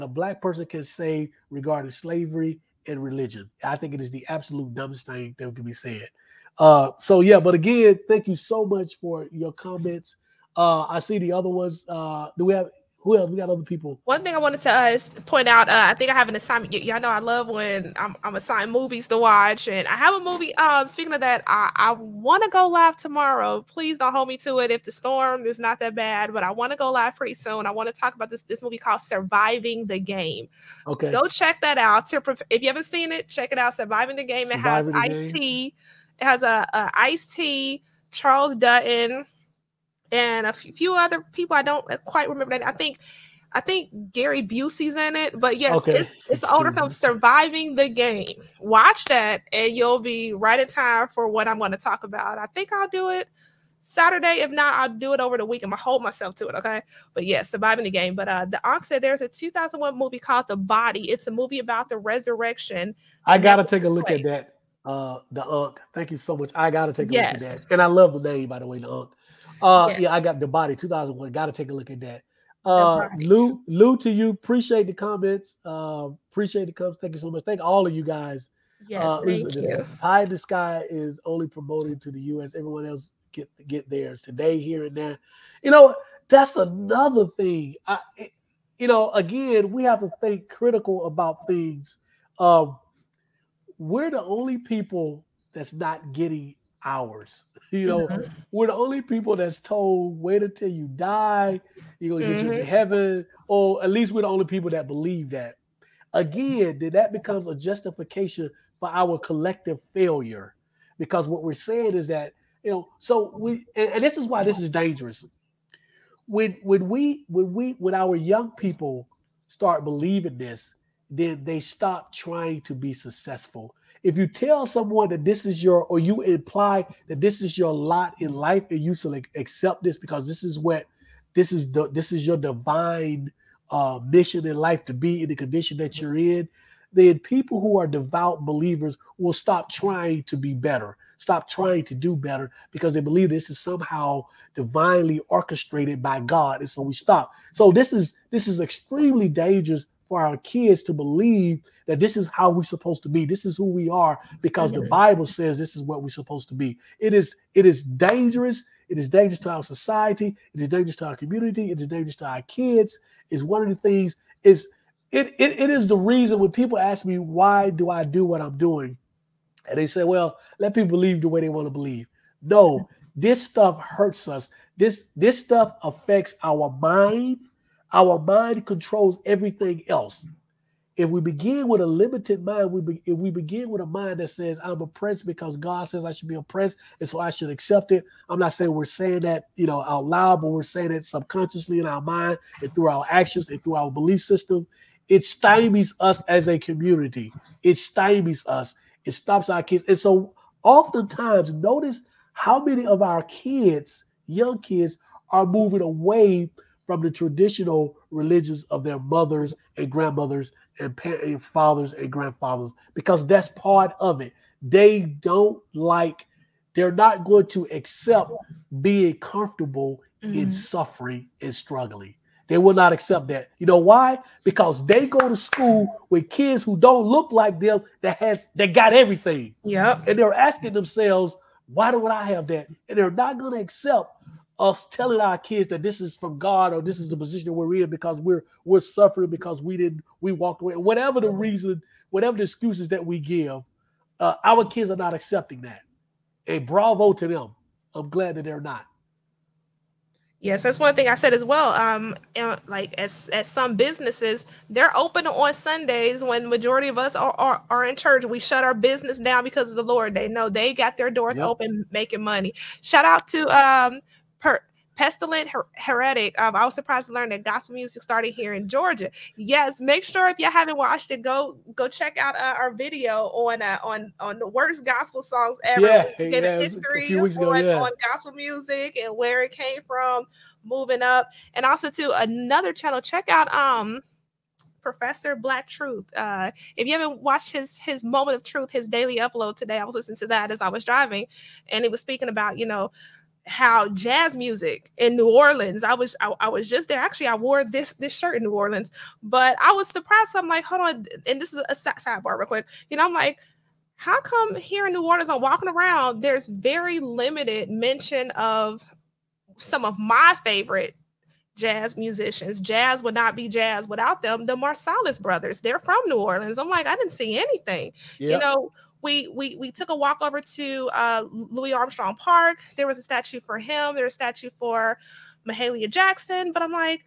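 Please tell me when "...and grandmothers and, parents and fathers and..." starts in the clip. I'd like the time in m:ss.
3:29.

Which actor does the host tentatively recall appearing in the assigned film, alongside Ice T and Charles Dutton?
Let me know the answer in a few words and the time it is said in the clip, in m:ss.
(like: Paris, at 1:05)
Gary Busey, at 0:44.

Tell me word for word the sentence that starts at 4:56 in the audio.
Actually, I wore this this shirt in New Orleans, but I was surprised.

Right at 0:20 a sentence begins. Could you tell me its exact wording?
Um, speaking of that, I, I want to go live tomorrow.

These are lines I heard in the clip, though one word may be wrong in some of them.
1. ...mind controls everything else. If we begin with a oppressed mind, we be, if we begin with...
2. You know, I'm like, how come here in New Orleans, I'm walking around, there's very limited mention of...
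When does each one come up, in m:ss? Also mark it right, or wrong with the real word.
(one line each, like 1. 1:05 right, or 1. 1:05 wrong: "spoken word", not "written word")
1. 2:58 wrong: "limited", not "oppressed"
2. 5:02 right.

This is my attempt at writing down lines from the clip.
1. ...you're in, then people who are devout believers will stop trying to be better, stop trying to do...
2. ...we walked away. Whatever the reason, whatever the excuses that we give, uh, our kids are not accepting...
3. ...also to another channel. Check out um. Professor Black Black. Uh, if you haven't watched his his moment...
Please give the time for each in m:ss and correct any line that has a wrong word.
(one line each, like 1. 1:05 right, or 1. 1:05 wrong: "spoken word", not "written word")
1. 2:15 right
2. 4:00 right
3. 4:41 wrong: "Truth", not "Black".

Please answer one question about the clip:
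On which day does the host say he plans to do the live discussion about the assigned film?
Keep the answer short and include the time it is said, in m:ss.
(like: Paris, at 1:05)
Saturday, at 0:53.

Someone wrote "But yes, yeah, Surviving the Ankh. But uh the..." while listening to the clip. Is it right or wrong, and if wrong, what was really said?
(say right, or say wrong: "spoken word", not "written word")
wrong: "Game", not "Ankh".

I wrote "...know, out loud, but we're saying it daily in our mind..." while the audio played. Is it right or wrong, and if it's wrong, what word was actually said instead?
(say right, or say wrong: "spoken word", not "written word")
wrong: "subconsciously", not "daily".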